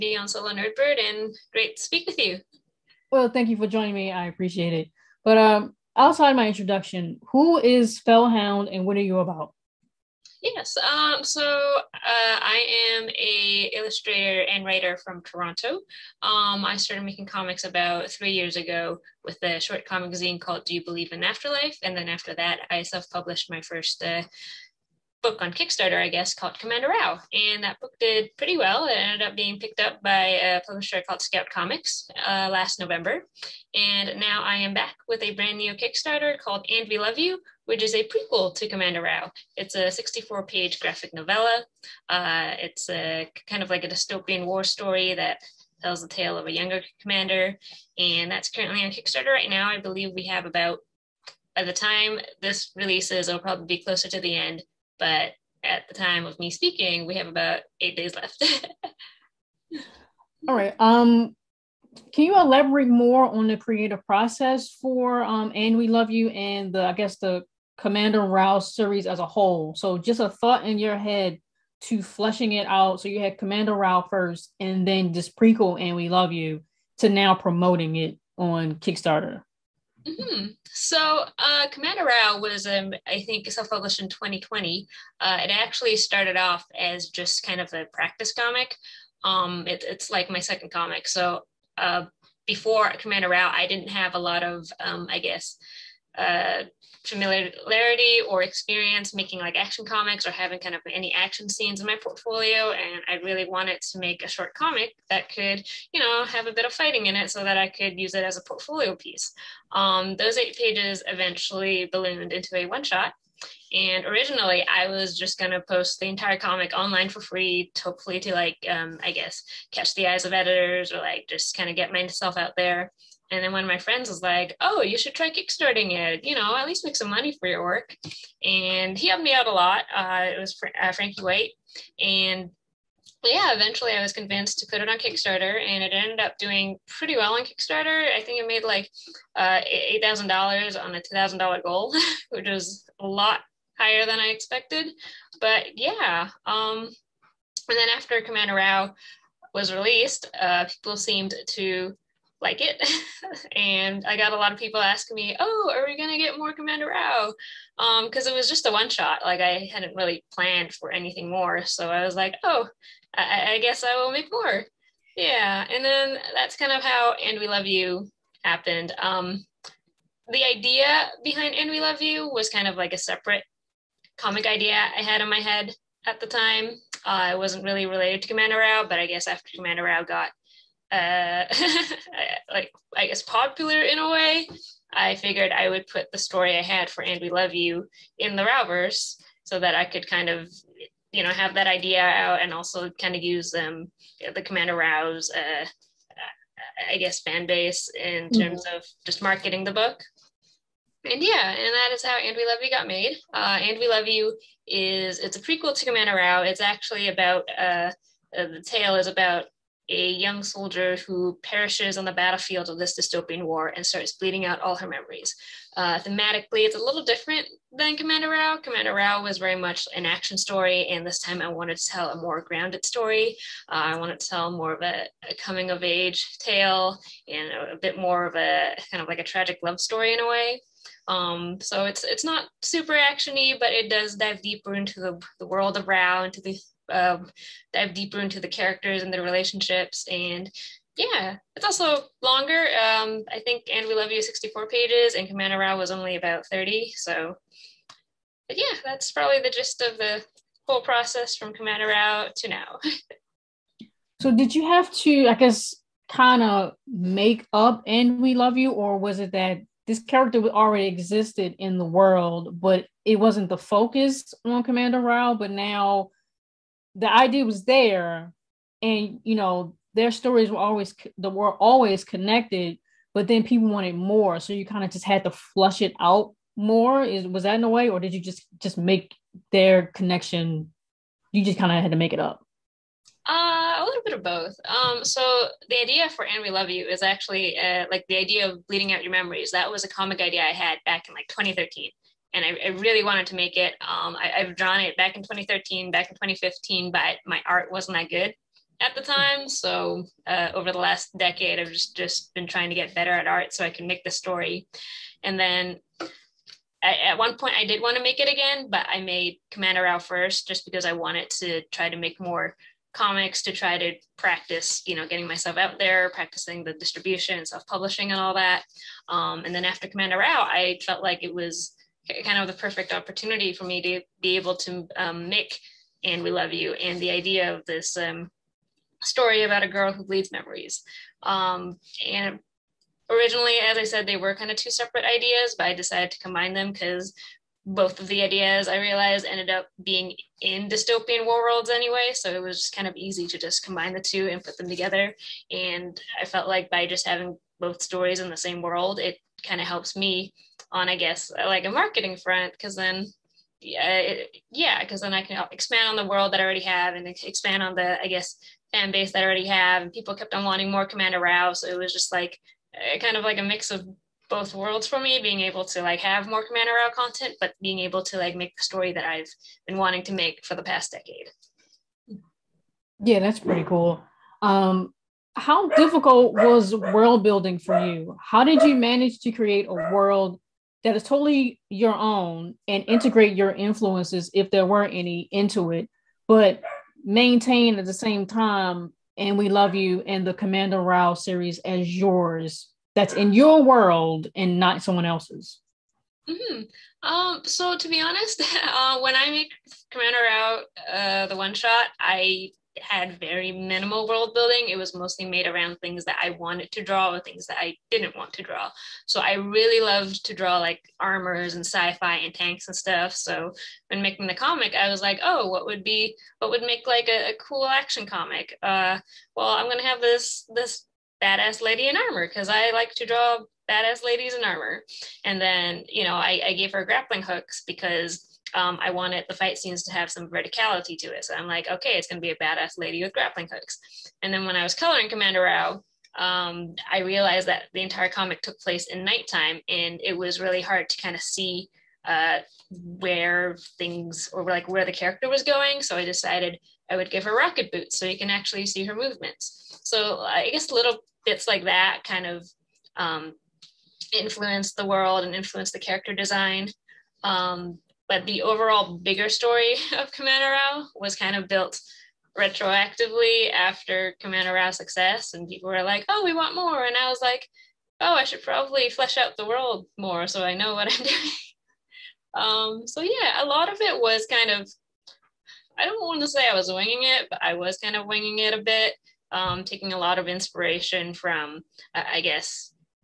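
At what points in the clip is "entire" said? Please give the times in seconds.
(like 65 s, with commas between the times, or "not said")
116 s, 437 s.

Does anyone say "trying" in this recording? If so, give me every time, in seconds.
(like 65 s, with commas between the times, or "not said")
302 s.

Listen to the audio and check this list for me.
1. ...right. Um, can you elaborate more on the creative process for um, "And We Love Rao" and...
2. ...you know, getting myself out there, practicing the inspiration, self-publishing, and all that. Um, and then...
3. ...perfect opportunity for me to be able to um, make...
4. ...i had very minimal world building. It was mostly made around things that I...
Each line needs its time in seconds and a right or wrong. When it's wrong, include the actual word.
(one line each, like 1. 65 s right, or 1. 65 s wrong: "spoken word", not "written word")
1. 60 s wrong: "You", not "Rao"
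2. 314 s wrong: "distribution", not "inspiration"
3. 322 s right
4. 401 s right.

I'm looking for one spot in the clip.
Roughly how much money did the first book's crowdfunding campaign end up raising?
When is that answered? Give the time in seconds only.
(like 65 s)
139 s.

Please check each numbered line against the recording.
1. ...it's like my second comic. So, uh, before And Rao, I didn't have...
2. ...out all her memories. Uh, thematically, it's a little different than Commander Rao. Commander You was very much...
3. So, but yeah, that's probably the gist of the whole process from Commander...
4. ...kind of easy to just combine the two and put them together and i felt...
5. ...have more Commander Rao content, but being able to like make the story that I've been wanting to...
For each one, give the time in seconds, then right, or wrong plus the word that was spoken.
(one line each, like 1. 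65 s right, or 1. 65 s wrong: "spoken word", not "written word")
1. 89 s wrong: "Commander", not "And"
2. 214 s wrong: "Rao", not "You"
3. 246 s right
4. 342 s right
5. 365 s right.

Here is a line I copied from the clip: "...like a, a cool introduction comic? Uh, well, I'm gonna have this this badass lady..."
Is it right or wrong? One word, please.
wrong.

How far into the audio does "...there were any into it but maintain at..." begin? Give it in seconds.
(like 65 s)
384 s.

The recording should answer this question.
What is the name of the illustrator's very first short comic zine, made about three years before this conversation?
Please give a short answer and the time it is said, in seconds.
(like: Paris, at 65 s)
Do You Believe in Afterlife?, at 20 s.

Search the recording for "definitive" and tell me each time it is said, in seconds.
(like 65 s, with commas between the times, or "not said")
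not said.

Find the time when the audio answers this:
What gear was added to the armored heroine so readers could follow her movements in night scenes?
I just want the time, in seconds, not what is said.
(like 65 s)
447 s.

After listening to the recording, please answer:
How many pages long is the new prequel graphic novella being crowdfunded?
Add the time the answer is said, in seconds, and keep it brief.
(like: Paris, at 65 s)
64, at 39 s.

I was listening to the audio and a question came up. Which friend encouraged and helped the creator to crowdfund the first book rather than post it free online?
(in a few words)
Frankee White.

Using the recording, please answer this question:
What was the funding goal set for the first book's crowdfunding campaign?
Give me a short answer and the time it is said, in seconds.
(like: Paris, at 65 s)
$2,000, at 141 s.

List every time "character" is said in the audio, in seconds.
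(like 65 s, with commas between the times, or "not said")
238 s, 259 s, 444 s, 455 s.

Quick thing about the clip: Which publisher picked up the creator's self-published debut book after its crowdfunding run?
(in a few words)
Scout Comics.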